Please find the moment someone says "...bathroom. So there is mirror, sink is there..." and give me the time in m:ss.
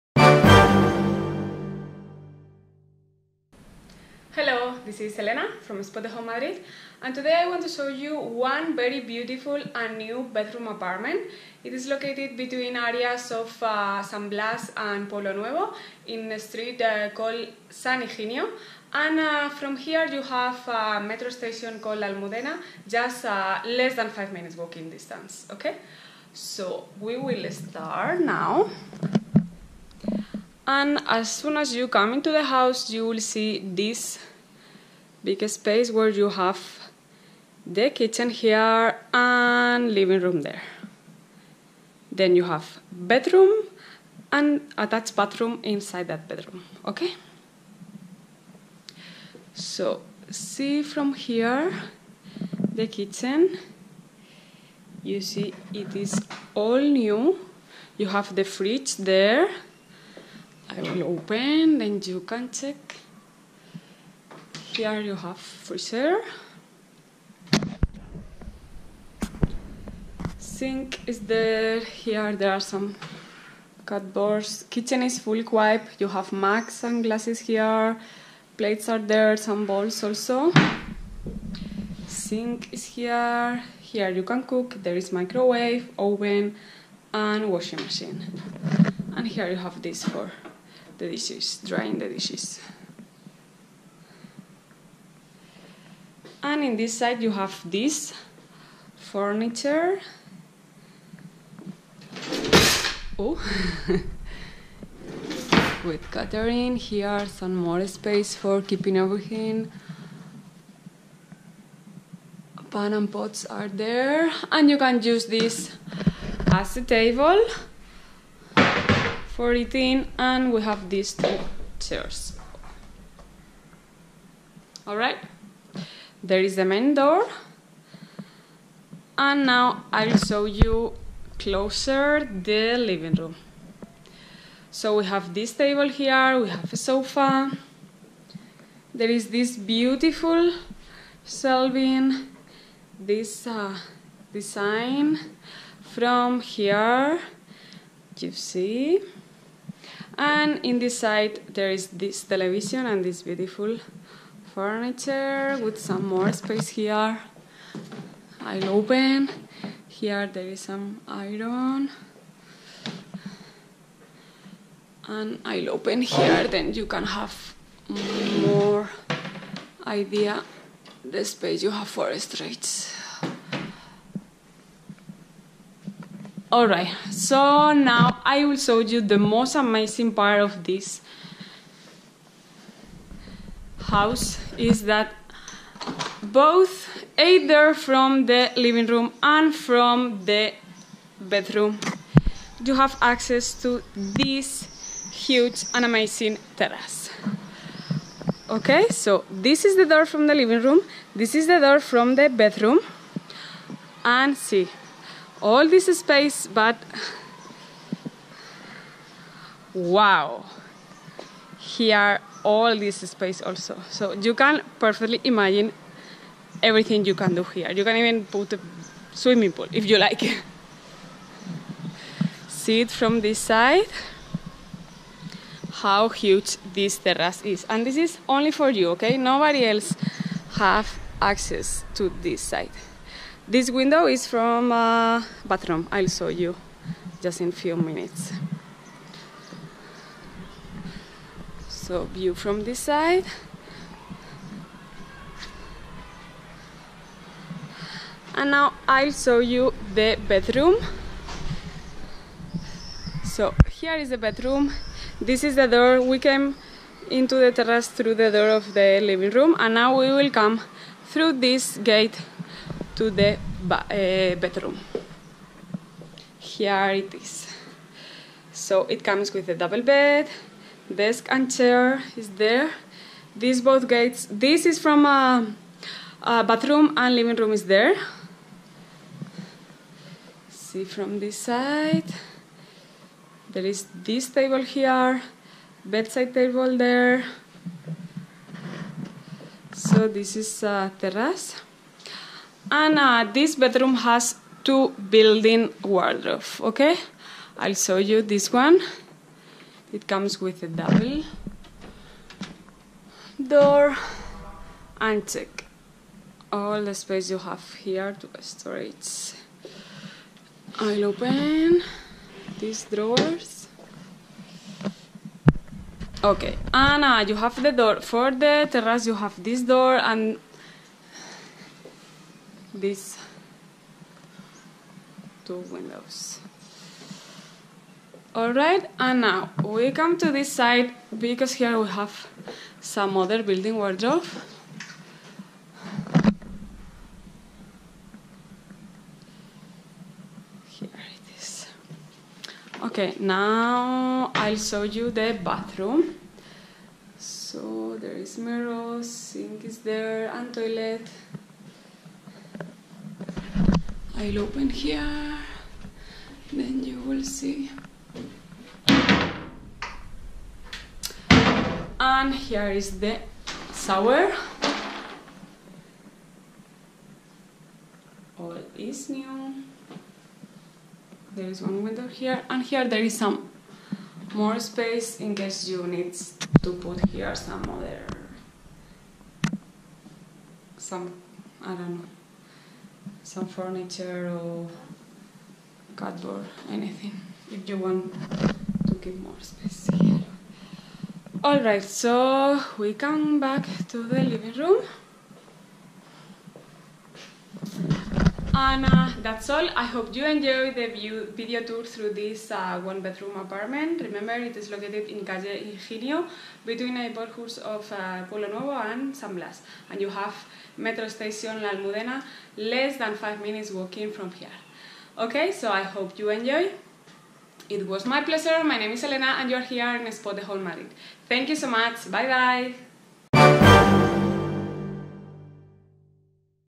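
5:45.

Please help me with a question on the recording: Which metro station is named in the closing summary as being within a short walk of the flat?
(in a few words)
La Almudena.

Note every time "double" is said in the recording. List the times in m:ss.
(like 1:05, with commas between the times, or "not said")
4:29, 5:00.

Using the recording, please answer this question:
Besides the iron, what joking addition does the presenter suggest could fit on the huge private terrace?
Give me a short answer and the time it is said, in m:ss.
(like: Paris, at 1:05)
swimming pool, at 3:39.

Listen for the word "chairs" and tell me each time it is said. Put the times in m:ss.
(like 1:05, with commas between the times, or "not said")
2:01, 4:31.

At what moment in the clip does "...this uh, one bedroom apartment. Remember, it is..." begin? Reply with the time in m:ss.
6:42.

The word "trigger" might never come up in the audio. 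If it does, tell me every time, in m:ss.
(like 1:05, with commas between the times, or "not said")
not said.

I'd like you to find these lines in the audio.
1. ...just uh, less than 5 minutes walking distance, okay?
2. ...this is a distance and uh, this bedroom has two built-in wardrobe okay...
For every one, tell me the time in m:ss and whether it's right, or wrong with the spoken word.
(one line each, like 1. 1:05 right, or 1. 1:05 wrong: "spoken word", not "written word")
1. 0:22 right
2. 4:50 wrong: "terrace", not "distance".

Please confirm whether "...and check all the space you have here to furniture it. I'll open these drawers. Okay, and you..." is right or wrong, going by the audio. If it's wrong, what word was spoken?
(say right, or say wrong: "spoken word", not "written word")
wrong: "store", not "furniture".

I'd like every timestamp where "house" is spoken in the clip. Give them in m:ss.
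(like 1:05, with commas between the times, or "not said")
0:32, 3:03.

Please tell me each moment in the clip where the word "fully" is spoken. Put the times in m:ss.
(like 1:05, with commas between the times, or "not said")
1:15.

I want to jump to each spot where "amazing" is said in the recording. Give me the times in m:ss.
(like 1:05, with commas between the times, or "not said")
2:59, 3:15.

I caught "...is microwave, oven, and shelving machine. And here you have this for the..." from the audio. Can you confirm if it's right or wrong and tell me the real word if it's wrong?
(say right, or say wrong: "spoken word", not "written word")
wrong: "washing", not "shelving".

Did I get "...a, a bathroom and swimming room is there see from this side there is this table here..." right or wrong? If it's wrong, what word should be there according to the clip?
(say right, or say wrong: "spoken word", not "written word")
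wrong: "living", not "swimming".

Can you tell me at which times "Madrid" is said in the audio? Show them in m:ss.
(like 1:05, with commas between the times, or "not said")
0:06, 7:00.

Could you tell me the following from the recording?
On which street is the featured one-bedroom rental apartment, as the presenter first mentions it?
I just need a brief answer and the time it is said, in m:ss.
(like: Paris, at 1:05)
San Higinio, at 0:17.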